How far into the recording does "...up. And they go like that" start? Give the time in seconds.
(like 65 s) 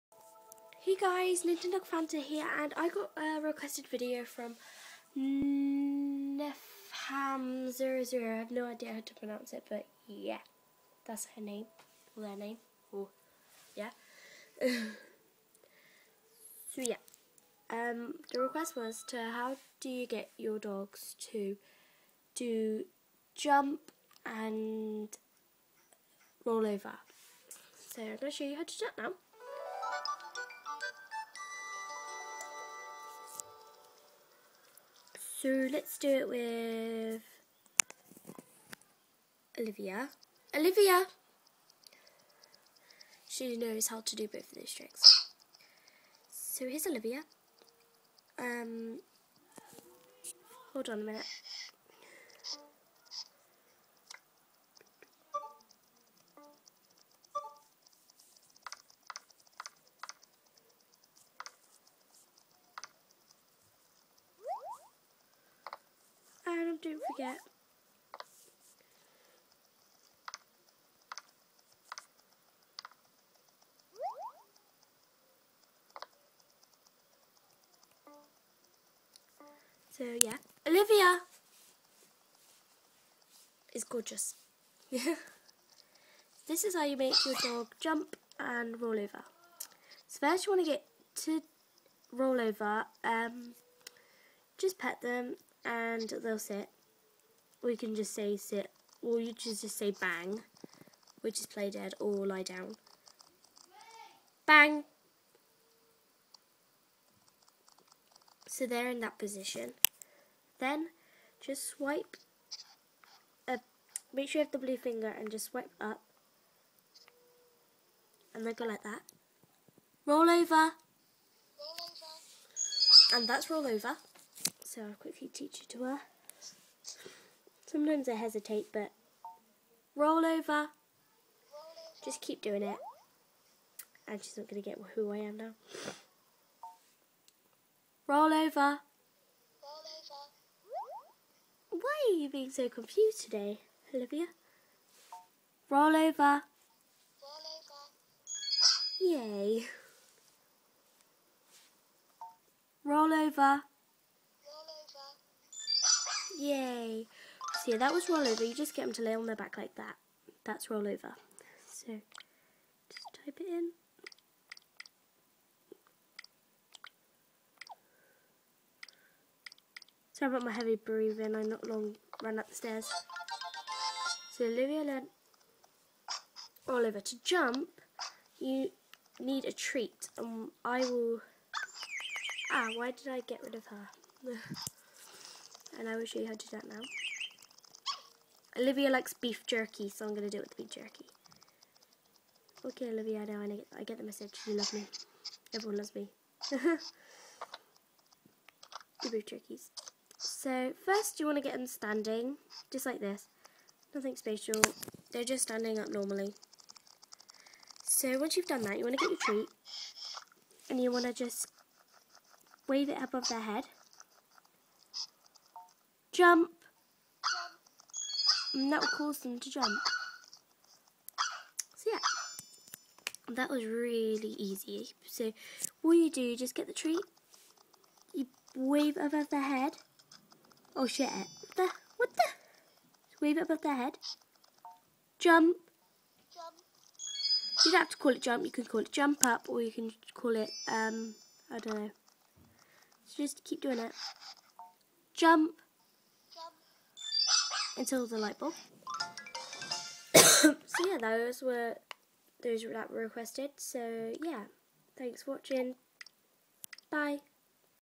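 115 s.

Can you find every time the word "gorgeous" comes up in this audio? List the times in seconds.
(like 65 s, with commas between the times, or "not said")
83 s.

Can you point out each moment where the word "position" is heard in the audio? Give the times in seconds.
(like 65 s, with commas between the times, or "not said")
109 s.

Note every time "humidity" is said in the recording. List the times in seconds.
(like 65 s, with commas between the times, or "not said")
not said.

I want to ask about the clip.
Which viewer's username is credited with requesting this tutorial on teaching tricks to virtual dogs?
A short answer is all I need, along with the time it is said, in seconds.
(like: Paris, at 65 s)
nepham00, at 5 s.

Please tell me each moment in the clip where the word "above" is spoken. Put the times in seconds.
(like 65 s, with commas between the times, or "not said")
213 s, 228 s, 233 s.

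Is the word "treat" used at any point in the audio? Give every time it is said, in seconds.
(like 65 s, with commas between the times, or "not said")
179 s, 209 s, 226 s.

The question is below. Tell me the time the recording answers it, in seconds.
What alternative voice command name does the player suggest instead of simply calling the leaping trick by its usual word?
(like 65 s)
238 s.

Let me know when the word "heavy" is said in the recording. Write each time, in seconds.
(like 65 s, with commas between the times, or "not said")
170 s.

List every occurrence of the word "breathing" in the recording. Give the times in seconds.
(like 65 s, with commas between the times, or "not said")
170 s.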